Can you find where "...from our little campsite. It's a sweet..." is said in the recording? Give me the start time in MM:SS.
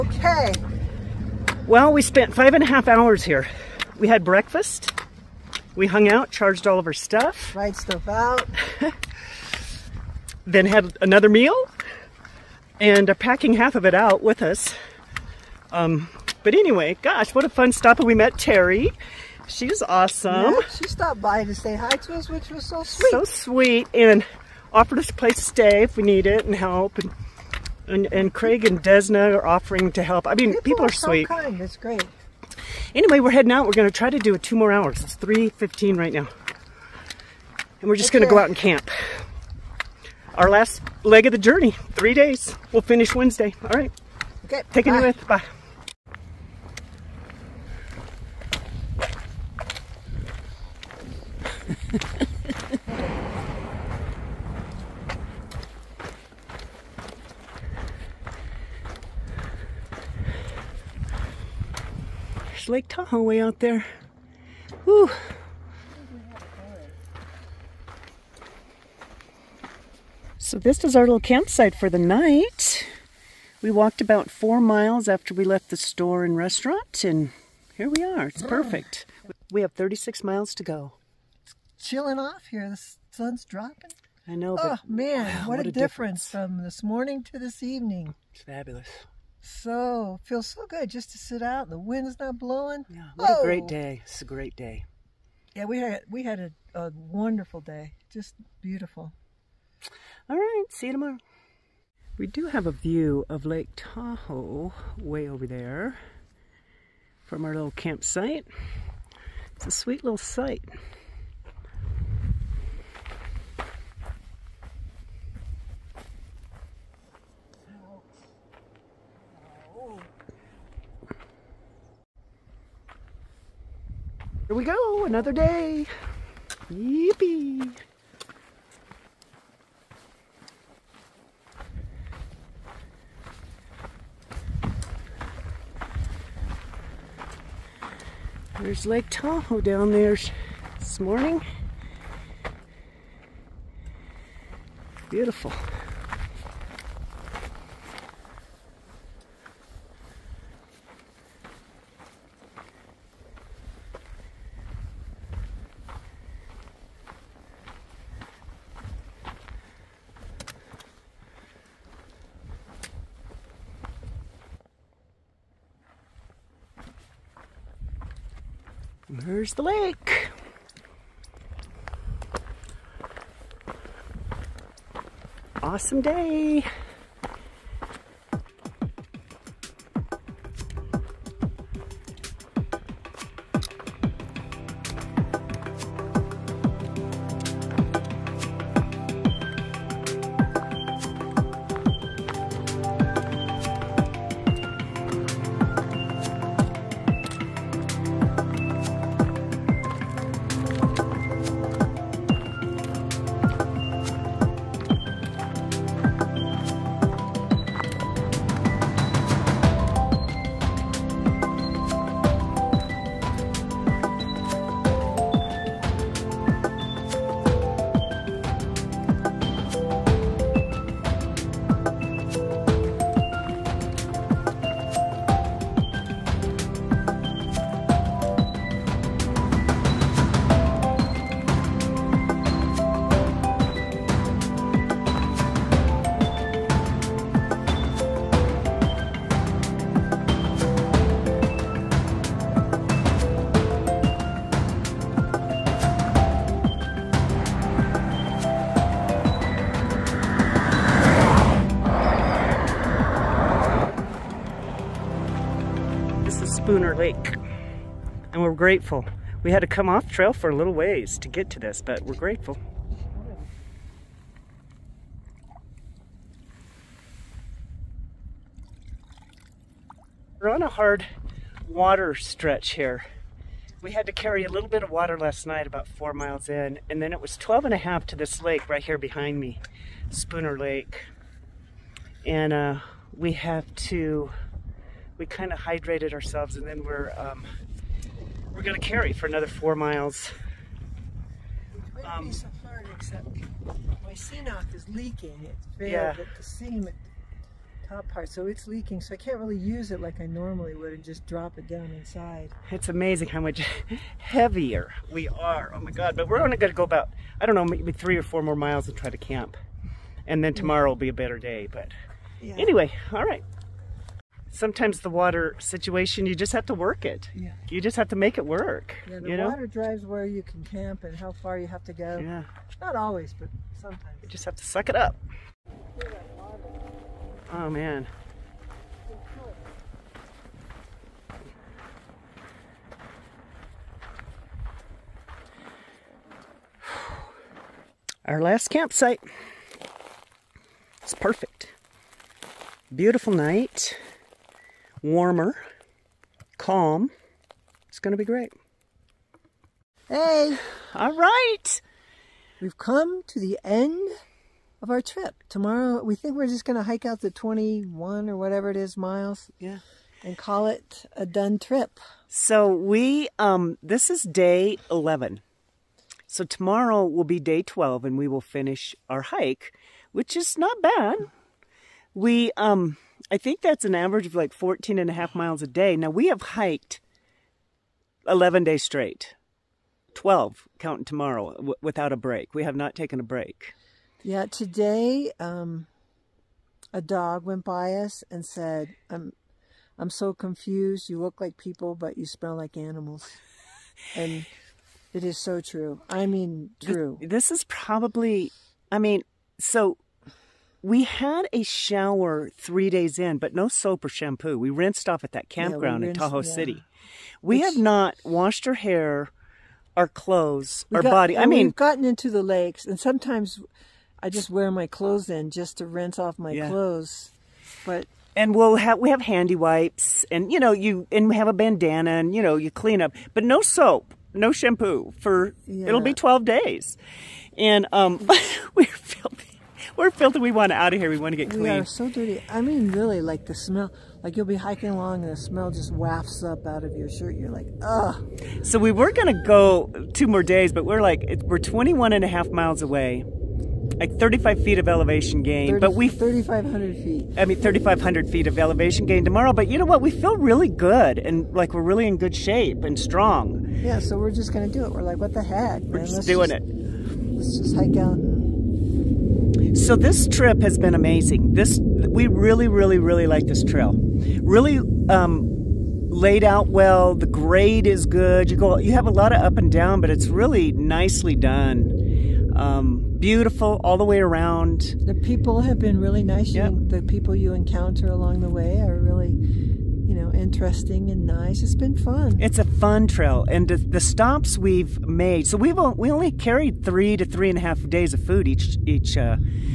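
01:47.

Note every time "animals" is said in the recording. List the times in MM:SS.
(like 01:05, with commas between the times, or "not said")
06:32.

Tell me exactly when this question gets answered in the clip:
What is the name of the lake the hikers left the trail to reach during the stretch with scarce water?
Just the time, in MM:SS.
04:40.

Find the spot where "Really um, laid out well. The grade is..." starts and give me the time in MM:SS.
07:44.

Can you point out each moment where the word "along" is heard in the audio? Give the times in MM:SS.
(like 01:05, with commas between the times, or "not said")
07:14, 07:58.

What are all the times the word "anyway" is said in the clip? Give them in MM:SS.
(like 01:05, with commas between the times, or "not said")
00:16, 00:32, 05:12.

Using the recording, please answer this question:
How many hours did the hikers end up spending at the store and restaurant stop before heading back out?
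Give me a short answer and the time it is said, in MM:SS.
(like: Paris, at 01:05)
5.5 hours, at 00:02.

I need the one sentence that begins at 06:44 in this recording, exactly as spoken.
We rinsed off at that campground yeah, rinsed, in Tahoe yeah.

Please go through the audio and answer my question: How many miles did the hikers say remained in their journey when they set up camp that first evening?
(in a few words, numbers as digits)
36.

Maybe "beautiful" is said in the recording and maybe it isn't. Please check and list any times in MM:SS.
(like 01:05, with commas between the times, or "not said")
01:38, 02:25, 05:42, 07:53.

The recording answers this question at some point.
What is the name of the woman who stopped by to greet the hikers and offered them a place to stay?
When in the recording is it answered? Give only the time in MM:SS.
00:18.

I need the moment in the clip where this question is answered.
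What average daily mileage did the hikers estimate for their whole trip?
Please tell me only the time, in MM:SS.
06:14.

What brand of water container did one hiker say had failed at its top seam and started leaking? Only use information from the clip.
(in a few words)
CNOC.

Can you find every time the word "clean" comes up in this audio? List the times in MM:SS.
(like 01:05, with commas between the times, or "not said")
07:02, 07:11.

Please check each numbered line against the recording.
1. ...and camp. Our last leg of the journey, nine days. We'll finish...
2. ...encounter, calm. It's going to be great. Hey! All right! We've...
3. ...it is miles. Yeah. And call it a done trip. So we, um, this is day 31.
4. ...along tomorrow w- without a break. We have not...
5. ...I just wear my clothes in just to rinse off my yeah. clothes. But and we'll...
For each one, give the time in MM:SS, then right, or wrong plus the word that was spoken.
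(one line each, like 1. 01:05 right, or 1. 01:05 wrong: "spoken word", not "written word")
1. 00:38 wrong: "three", not "nine"
2. 05:45 wrong: "warmer", not "encounter"
3. 05:58 wrong: "11", not "31"
4. 06:20 wrong: "counting", not "along"
5. 06:54 right.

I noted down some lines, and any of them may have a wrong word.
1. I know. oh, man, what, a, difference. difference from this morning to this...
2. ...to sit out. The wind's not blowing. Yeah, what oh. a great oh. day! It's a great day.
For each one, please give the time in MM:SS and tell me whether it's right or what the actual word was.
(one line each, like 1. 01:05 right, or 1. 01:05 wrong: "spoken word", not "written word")
1. 01:24 right
2. 01:31 right.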